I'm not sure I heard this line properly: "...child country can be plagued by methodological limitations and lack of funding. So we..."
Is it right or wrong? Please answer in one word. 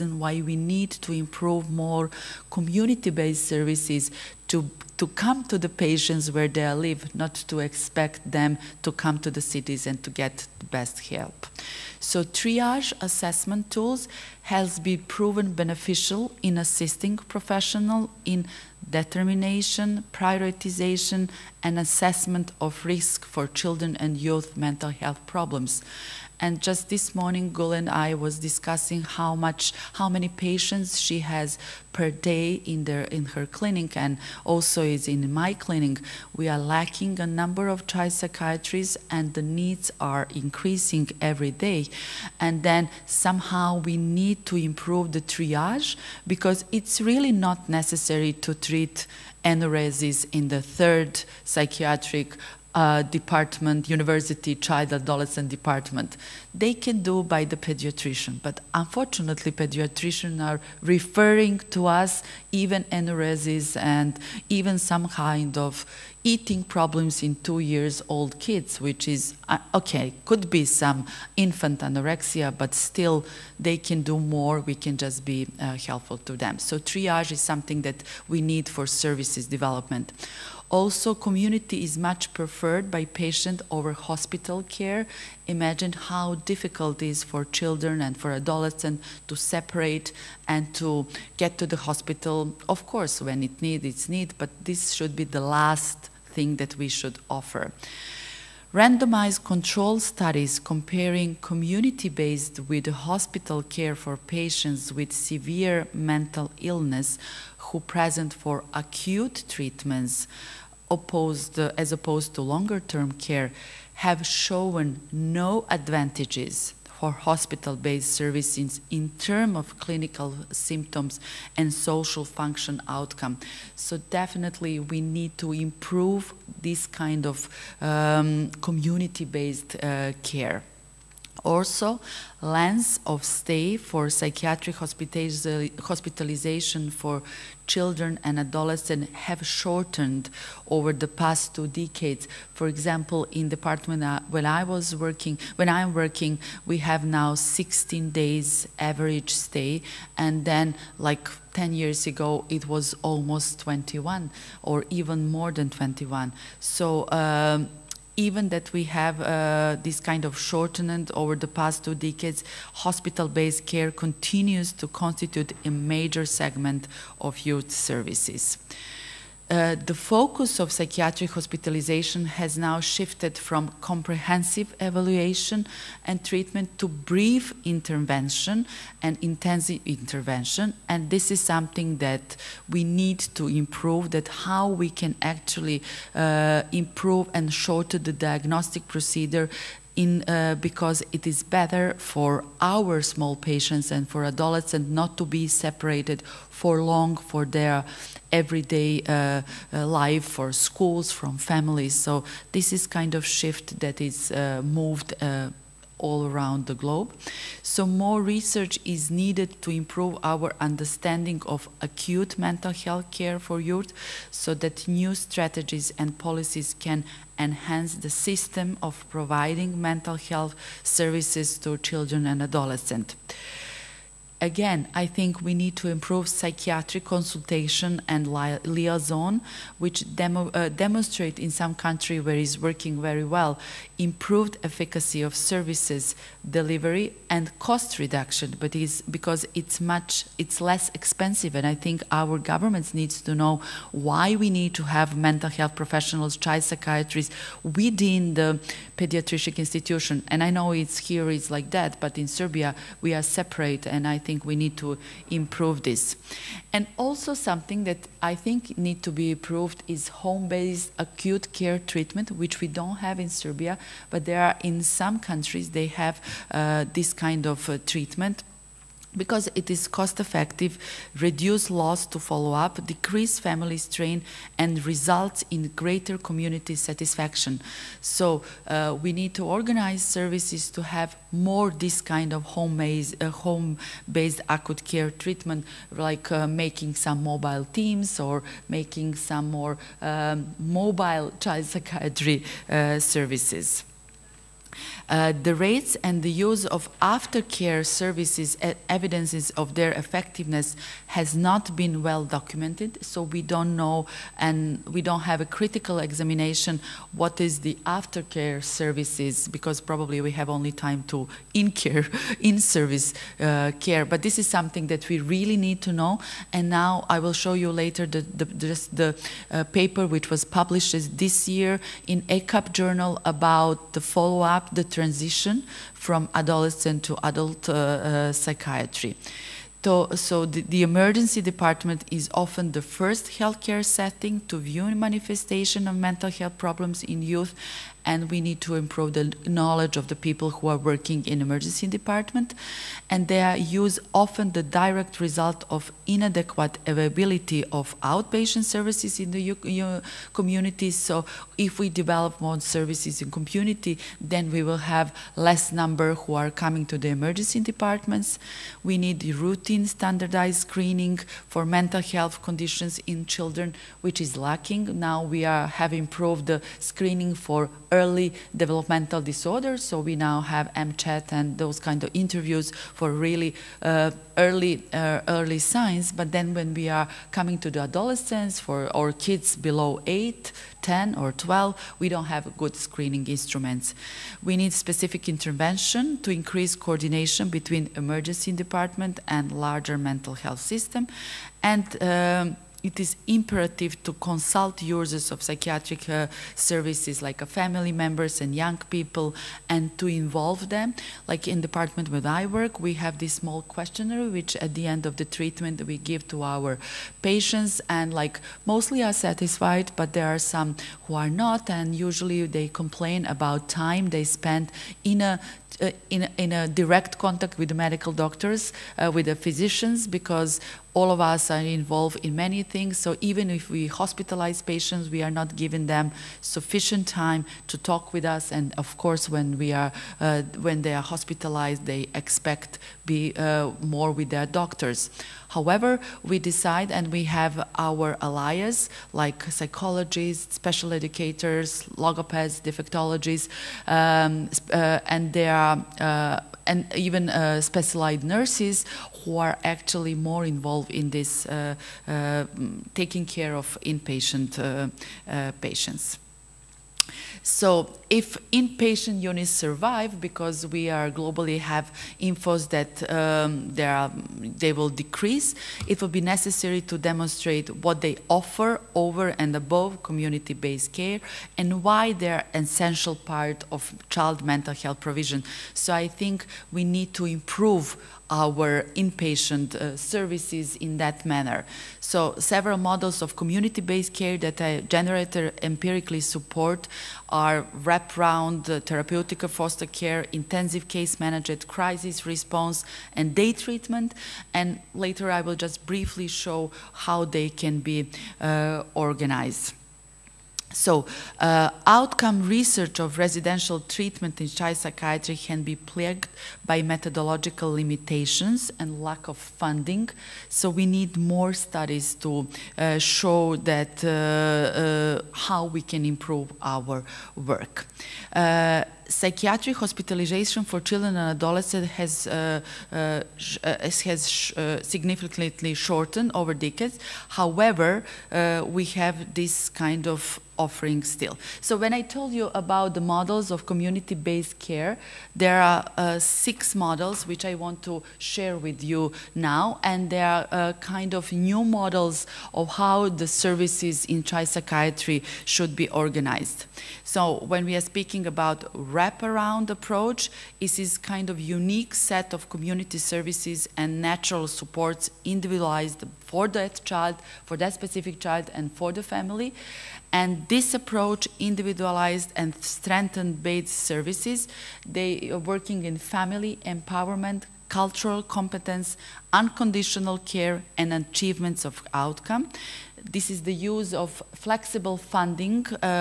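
wrong.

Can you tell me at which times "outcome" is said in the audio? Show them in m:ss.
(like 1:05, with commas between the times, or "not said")
2:02, 8:21, 9:31.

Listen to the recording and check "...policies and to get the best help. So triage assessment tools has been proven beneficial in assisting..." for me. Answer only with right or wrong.
wrong.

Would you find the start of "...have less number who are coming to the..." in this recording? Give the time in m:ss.
5:54.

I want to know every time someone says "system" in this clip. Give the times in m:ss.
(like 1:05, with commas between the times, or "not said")
3:38, 6:30.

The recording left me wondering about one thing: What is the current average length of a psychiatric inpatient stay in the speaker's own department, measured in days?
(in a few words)
16 days.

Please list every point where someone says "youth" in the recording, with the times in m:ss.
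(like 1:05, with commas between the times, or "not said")
0:24, 2:47, 3:33, 5:37.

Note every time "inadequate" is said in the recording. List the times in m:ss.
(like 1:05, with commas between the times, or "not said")
5:46.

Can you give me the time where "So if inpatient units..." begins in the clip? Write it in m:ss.
7:37.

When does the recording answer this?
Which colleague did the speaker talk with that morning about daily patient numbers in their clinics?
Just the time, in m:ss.
0:27.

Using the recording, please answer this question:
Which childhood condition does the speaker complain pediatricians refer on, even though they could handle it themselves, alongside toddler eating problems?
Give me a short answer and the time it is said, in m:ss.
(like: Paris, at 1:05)
Enuresis, at 1:02.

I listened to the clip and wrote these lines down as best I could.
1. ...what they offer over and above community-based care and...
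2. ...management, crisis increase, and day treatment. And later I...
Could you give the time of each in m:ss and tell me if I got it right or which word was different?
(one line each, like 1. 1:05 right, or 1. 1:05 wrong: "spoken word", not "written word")
1. 7:47 right
2. 8:11 wrong: "response", not "increase".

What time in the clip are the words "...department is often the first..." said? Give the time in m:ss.
5:31.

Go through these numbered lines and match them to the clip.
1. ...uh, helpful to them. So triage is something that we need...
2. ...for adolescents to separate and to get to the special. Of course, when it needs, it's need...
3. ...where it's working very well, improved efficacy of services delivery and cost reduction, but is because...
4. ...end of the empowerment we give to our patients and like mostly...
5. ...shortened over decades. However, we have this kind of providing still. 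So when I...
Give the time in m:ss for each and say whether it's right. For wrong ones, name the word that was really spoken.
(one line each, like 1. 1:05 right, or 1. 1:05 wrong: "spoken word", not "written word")
1. 1:15 right
2. 1:28 wrong: "hospital", not "special"
3. 3:52 right
4. 6:44 wrong: "treatment", not "empowerment"
5. 8:45 wrong: "offering", not "providing".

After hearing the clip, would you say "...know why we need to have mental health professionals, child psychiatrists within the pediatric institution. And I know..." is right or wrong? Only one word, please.
right.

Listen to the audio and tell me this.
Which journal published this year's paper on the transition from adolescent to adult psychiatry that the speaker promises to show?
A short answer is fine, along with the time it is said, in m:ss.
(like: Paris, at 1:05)
ECAP, at 5:22.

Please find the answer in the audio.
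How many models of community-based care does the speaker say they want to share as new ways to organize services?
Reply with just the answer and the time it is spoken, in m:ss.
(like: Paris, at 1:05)
6, at 8:56.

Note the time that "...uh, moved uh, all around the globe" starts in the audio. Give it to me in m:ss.
3:24.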